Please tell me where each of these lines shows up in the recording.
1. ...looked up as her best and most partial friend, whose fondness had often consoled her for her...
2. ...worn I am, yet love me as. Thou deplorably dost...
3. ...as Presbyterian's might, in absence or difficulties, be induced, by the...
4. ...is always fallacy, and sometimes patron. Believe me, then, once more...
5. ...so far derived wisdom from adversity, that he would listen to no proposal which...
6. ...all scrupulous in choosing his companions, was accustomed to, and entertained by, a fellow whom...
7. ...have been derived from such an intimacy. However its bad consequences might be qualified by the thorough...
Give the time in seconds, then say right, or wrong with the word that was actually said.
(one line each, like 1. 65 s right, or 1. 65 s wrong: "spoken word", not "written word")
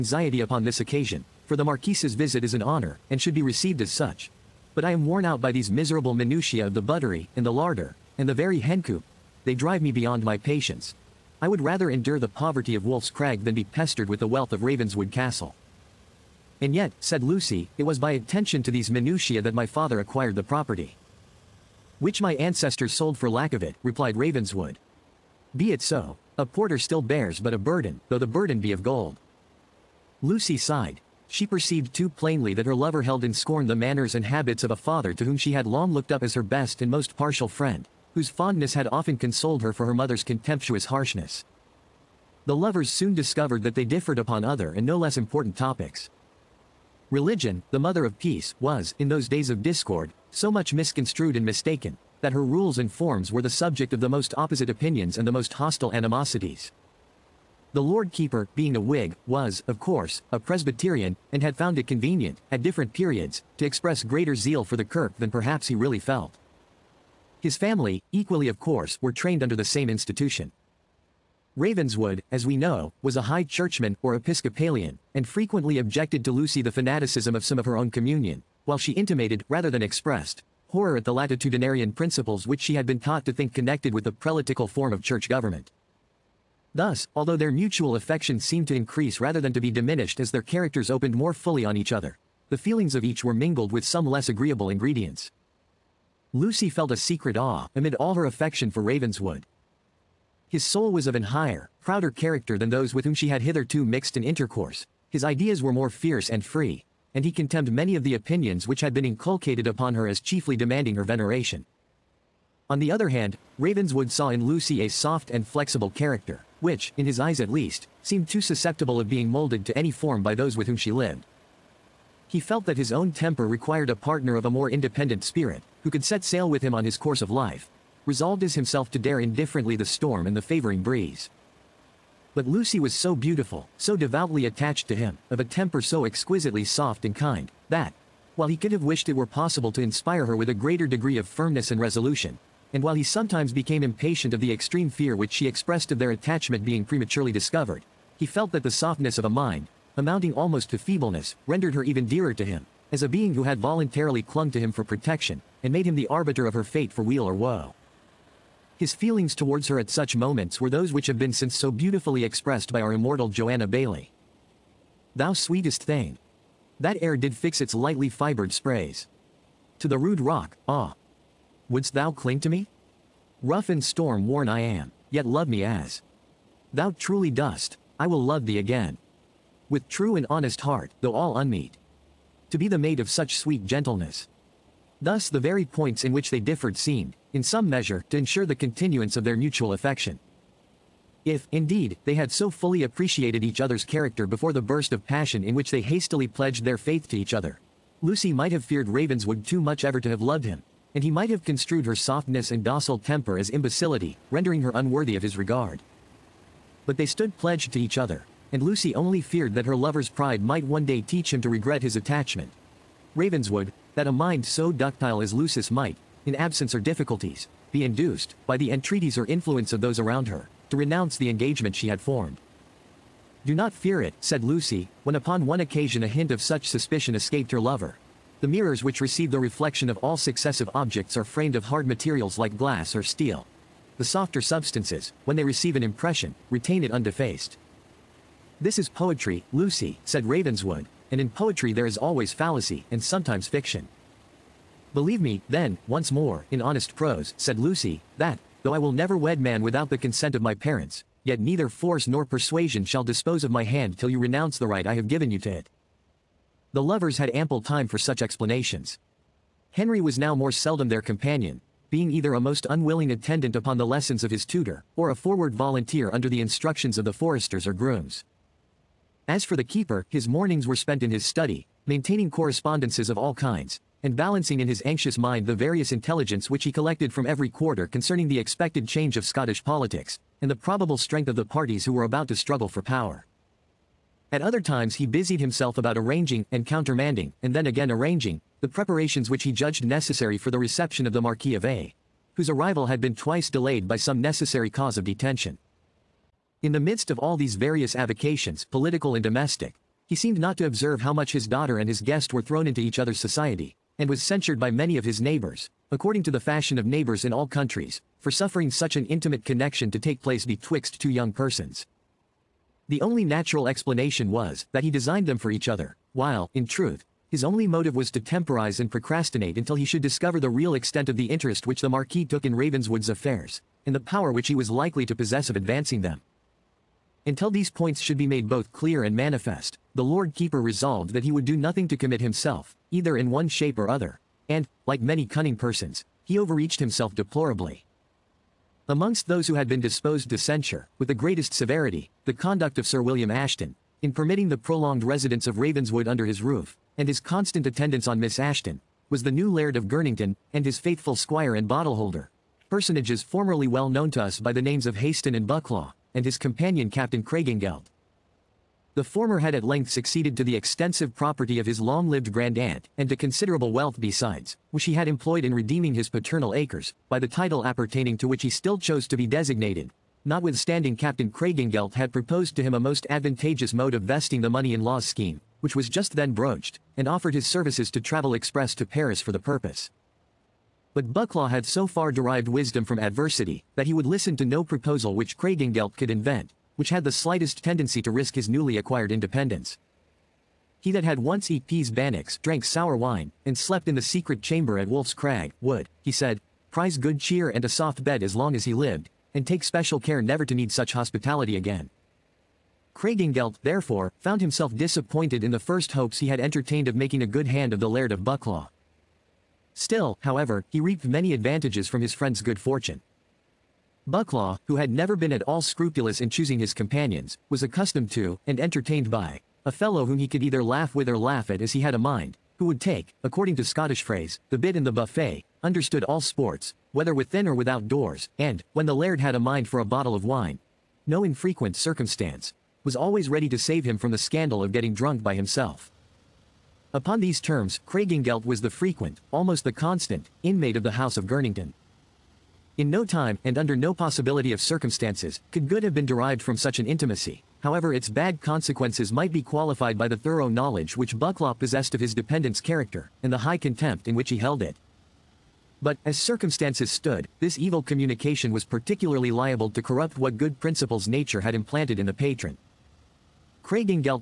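1. 35 s right
2. 174 s wrong: "truly", not "deplorably"
3. 215 s wrong: "Lucy", not "Presbyterian"
4. 241 s wrong: "fiction", not "patron"
5. 381 s right
6. 415 s right
7. 445 s right.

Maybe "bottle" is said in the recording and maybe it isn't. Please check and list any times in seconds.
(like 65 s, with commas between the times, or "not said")
351 s, 429 s.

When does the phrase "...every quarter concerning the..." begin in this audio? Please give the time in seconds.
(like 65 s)
277 s.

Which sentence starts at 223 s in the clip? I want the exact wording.
Do not fear it, said Lucy, when upon one occasion a hint of such suspicion escaped her lover.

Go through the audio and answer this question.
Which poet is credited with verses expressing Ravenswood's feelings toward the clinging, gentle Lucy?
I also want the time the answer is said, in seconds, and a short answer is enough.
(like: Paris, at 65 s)
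Joanna Baillie, at 163 s.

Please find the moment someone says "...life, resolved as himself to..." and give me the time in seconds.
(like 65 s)
127 s.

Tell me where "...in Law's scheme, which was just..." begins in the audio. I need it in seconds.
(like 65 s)
374 s.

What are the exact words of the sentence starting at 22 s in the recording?
Which my ancestors sold for lack of it, replied Ravenswood.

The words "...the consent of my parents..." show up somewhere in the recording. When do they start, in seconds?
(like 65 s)
249 s.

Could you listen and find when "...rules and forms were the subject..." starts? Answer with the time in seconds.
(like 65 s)
52 s.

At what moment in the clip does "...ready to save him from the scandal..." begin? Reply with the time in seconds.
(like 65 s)
433 s.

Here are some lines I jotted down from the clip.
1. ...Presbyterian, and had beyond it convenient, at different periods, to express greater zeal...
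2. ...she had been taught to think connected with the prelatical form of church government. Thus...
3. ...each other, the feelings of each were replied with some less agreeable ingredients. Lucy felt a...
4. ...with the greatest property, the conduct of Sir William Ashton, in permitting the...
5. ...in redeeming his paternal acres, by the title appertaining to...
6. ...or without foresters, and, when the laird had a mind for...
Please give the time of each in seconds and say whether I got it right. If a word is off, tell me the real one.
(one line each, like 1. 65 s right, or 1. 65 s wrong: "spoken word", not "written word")
1. 60 s wrong: "found", not "beyond"
2. 82 s right
3. 91 s wrong: "mingled", not "replied"
4. 340 s wrong: "severity", not "property"
5. 365 s right
6. 427 s wrong: "doors", not "foresters".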